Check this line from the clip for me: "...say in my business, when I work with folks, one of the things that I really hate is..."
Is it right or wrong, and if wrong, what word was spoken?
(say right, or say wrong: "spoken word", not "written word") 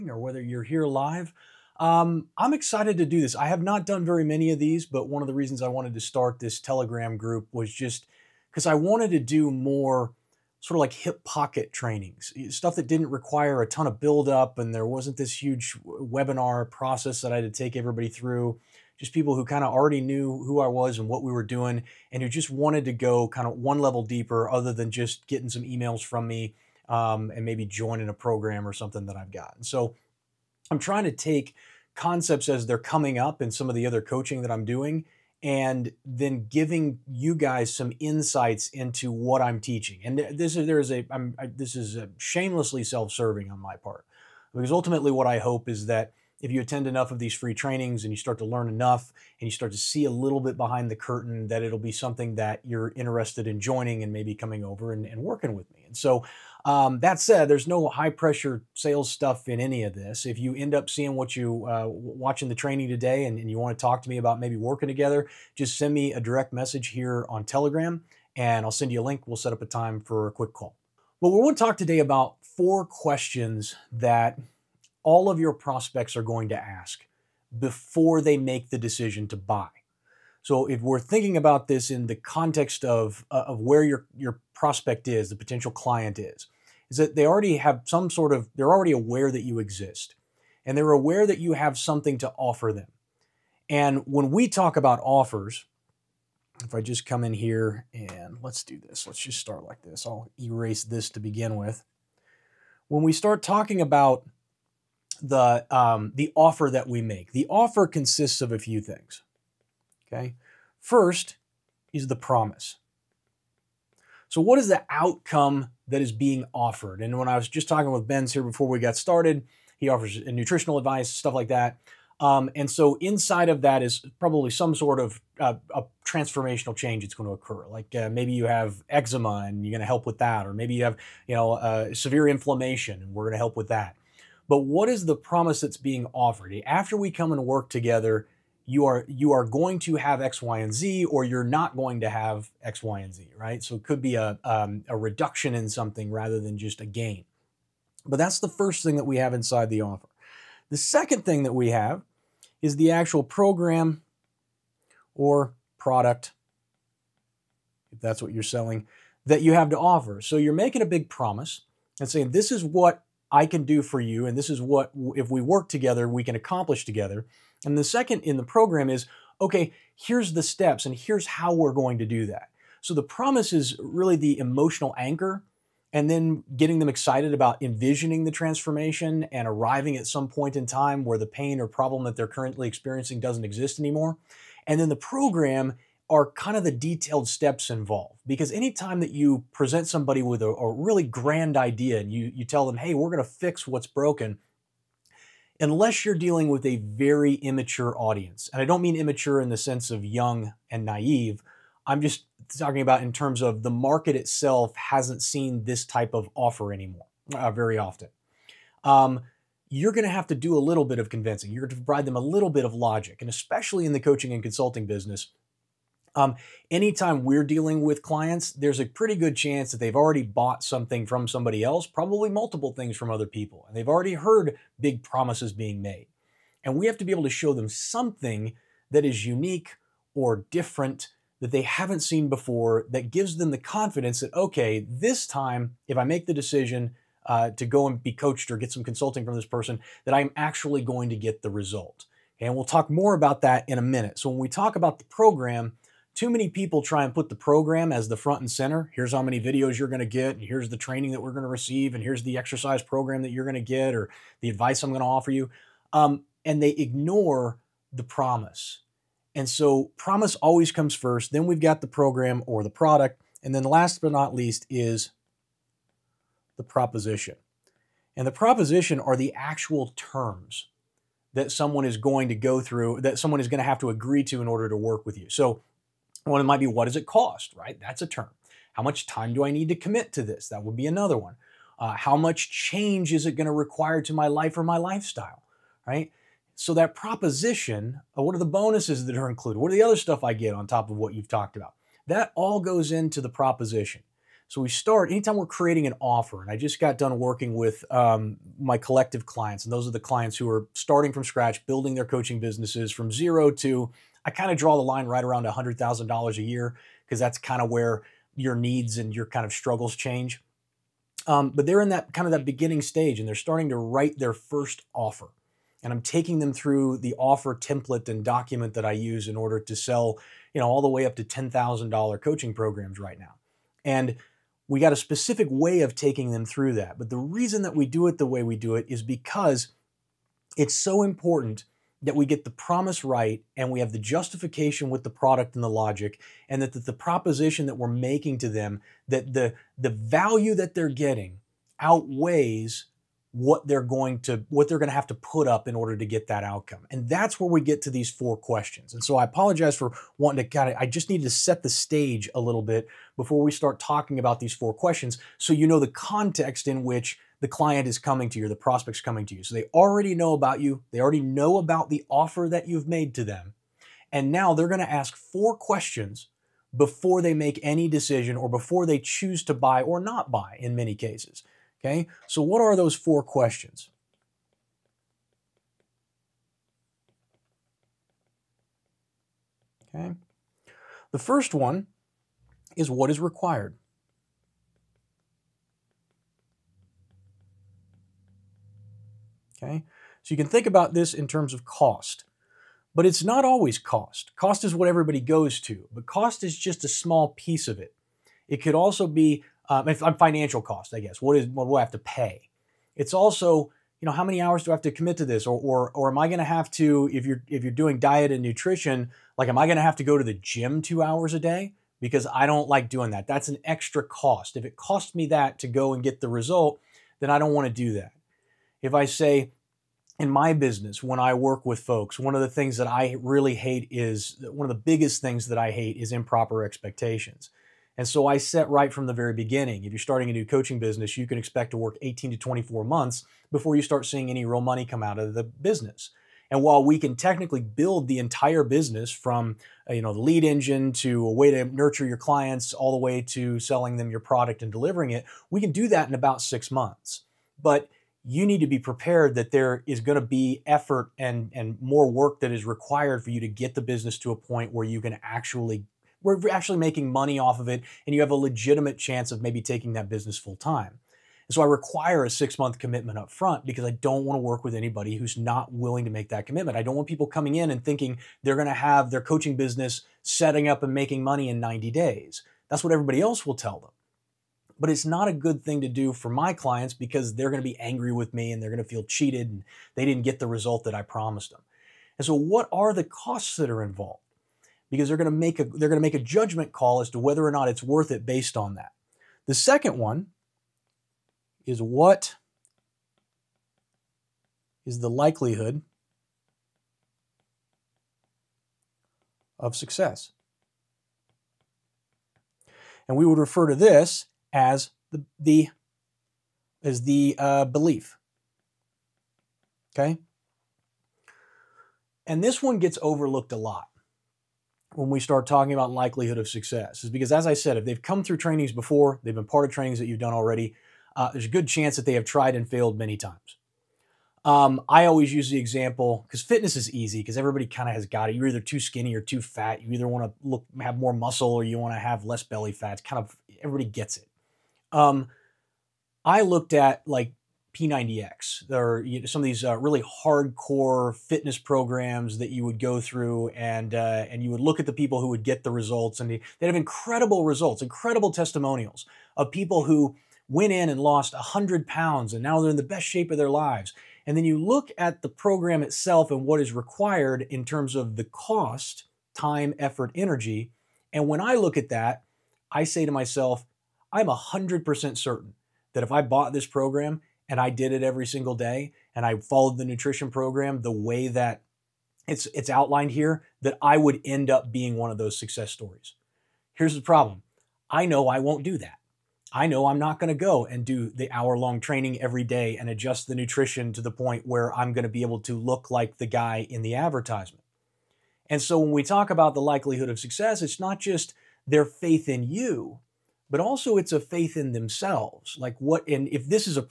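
right.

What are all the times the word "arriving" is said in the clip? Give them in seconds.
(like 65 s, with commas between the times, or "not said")
179 s.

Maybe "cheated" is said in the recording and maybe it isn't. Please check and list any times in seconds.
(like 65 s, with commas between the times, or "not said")
479 s.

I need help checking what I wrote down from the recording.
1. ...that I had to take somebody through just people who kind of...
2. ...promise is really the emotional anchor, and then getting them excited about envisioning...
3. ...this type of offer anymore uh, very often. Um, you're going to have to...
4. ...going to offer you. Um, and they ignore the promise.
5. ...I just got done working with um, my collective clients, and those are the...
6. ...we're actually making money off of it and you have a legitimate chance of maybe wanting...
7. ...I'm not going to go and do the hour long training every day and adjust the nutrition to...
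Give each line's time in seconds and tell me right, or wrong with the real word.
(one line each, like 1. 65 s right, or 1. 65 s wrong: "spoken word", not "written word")
1. 17 s wrong: "everybody", not "somebody"
2. 173 s right
3. 205 s right
4. 254 s right
5. 296 s right
6. 456 s wrong: "taking", not "wanting"
7. 579 s right.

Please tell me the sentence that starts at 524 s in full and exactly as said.
Um, I always use the example because fitness is easy because everybody kind of has got it.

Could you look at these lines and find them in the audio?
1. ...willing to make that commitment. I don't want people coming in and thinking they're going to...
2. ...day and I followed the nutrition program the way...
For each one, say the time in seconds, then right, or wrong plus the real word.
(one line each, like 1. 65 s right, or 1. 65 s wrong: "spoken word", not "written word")
1. 465 s right
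2. 568 s right.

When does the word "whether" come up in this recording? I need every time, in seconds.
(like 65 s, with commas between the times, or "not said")
0 s, 487 s.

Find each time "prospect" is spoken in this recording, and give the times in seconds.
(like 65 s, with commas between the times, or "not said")
75 s, 84 s, 358 s.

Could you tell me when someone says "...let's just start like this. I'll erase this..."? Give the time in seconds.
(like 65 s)
99 s.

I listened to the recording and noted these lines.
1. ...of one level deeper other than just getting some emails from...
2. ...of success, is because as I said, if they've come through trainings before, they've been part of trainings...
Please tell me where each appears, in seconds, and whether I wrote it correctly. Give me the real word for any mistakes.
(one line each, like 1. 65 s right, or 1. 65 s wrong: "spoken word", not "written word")
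1. 23 s right
2. 516 s right.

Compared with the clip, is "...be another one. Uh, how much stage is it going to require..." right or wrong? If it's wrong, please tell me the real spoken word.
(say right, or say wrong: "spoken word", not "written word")
wrong: "change", not "stage".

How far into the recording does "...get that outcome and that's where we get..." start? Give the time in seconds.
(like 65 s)
346 s.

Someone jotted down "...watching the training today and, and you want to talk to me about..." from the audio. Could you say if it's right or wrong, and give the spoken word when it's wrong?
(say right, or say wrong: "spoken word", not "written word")
right.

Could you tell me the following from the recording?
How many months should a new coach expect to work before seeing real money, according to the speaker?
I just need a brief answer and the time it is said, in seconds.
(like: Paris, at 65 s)
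18 to 24 months, at 432 s.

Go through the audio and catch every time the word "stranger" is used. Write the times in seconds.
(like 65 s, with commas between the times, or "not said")
not said.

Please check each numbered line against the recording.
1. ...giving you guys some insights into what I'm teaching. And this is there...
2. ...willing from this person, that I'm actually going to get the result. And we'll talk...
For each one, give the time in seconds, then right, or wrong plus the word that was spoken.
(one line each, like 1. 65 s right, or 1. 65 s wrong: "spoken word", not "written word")
1. 36 s right
2. 238 s wrong: "consulting", not "willing".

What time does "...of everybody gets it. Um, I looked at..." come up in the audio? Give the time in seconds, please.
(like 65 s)
533 s.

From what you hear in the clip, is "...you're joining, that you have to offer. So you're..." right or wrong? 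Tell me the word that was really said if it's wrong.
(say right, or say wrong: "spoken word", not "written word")
wrong: "selling", not "joining".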